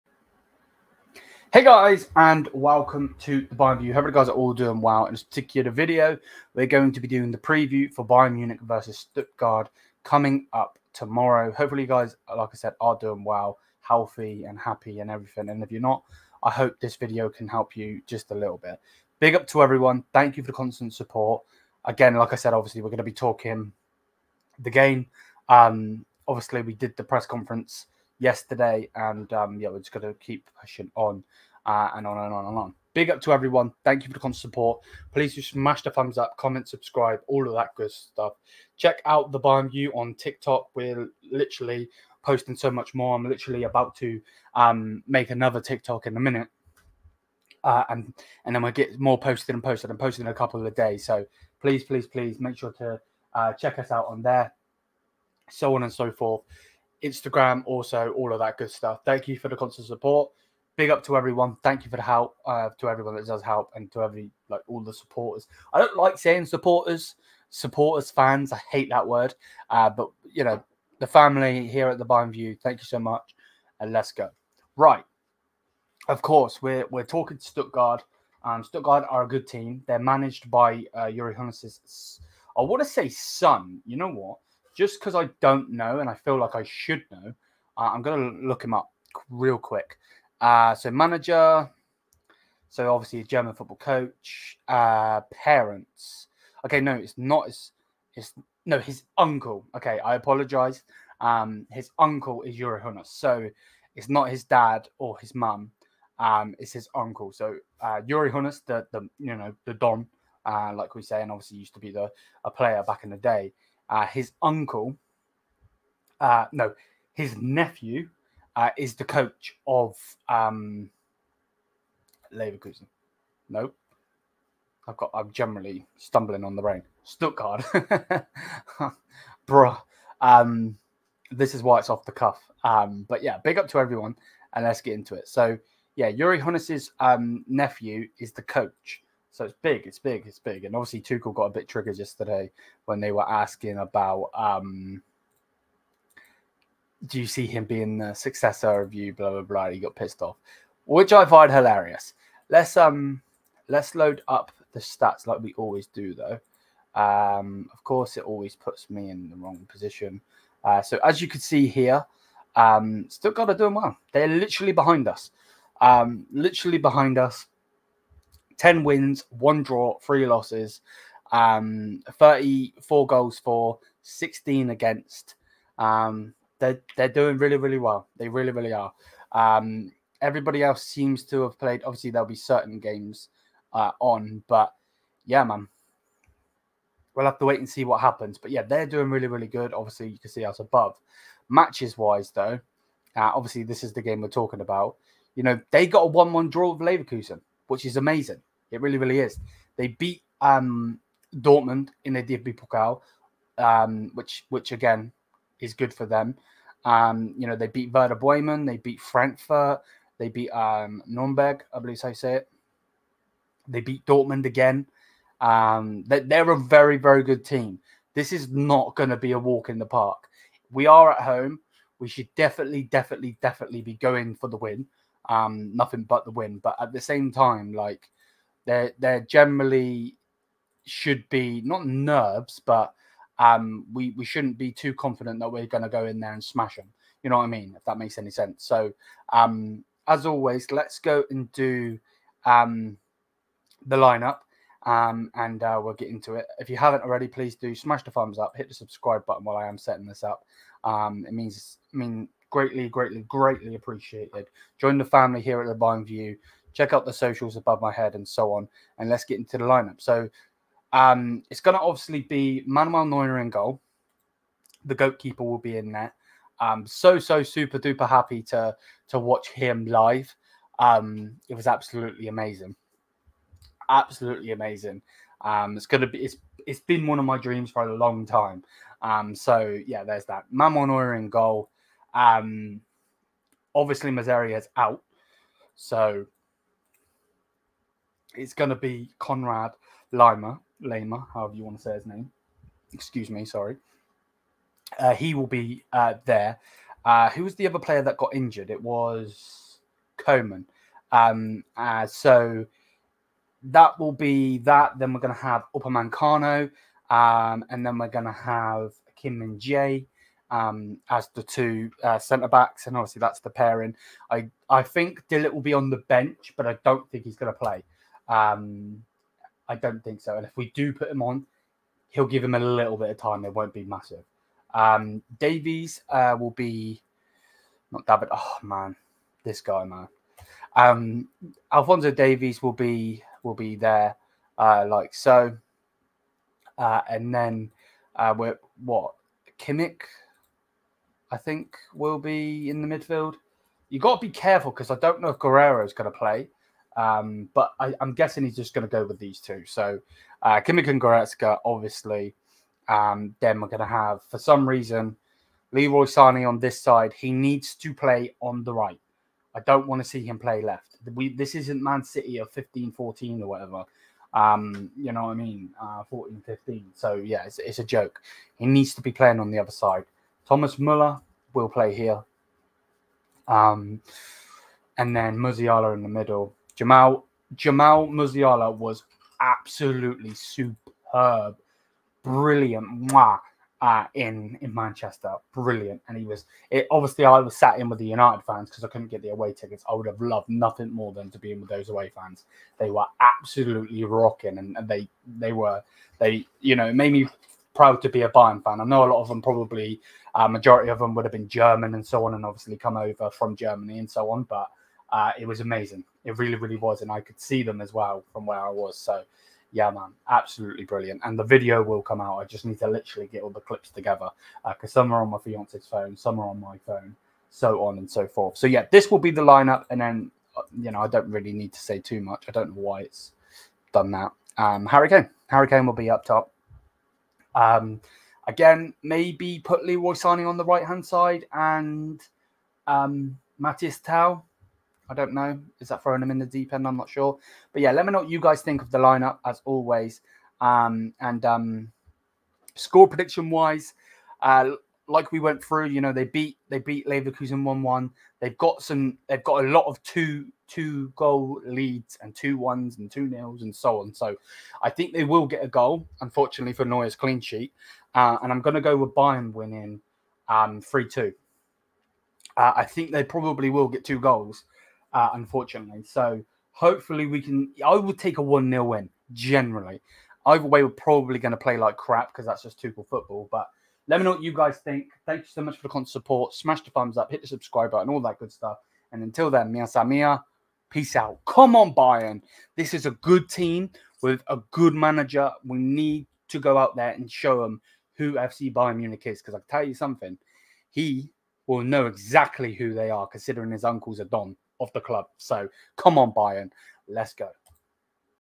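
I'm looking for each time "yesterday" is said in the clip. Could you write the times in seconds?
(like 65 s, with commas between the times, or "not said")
28 s, 141 s.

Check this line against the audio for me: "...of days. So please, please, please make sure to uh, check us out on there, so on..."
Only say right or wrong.
right.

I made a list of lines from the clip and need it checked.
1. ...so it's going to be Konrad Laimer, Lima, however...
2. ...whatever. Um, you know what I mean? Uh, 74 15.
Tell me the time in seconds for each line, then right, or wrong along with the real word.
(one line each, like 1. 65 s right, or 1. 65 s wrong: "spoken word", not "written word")
1. 285 s right
2. 363 s wrong: "14", not "74".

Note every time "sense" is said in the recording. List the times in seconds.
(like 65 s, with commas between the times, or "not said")
238 s.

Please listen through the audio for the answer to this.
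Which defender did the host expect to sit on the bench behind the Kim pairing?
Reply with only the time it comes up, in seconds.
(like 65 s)
315 s.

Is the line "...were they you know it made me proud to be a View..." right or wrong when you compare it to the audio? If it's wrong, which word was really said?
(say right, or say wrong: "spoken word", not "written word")
wrong: "Bayern", not "View".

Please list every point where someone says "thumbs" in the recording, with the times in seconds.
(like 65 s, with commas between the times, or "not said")
35 s, 248 s, 476 s.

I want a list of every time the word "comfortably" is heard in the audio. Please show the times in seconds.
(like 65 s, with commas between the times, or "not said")
not said.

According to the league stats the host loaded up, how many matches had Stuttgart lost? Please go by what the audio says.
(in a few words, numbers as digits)
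3.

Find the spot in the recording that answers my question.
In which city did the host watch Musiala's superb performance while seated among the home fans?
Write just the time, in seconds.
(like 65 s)
384 s.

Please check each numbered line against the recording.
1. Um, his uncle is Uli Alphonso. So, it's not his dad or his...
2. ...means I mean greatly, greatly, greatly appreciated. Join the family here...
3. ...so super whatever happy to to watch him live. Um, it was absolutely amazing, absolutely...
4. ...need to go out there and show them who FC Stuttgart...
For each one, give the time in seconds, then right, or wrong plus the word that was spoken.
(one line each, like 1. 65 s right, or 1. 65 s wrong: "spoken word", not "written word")
1. 101 s wrong: "Hoeneß", not "Alphonso"
2. 251 s right
3. 267 s wrong: "duper", not "whatever"
4. 485 s wrong: "Bayern", not "Stuttgart".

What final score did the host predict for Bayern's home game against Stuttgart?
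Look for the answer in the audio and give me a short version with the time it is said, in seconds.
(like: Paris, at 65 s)
3-2, at 460 s.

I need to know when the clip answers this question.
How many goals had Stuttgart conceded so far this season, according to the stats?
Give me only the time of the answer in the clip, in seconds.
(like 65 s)
174 s.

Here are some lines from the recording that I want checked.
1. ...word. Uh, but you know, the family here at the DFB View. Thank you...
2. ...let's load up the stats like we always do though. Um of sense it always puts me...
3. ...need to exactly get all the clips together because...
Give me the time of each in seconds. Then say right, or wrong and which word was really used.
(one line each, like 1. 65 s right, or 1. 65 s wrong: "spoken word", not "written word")
1. 69 s wrong: "Bayern", not "DFB"
2. 153 s wrong: "course", not "sense"
3. 412 s wrong: "literally", not "exactly".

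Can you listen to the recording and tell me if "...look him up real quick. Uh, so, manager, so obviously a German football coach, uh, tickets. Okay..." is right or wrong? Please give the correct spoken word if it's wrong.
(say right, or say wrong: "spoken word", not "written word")
wrong: "parents", not "tickets".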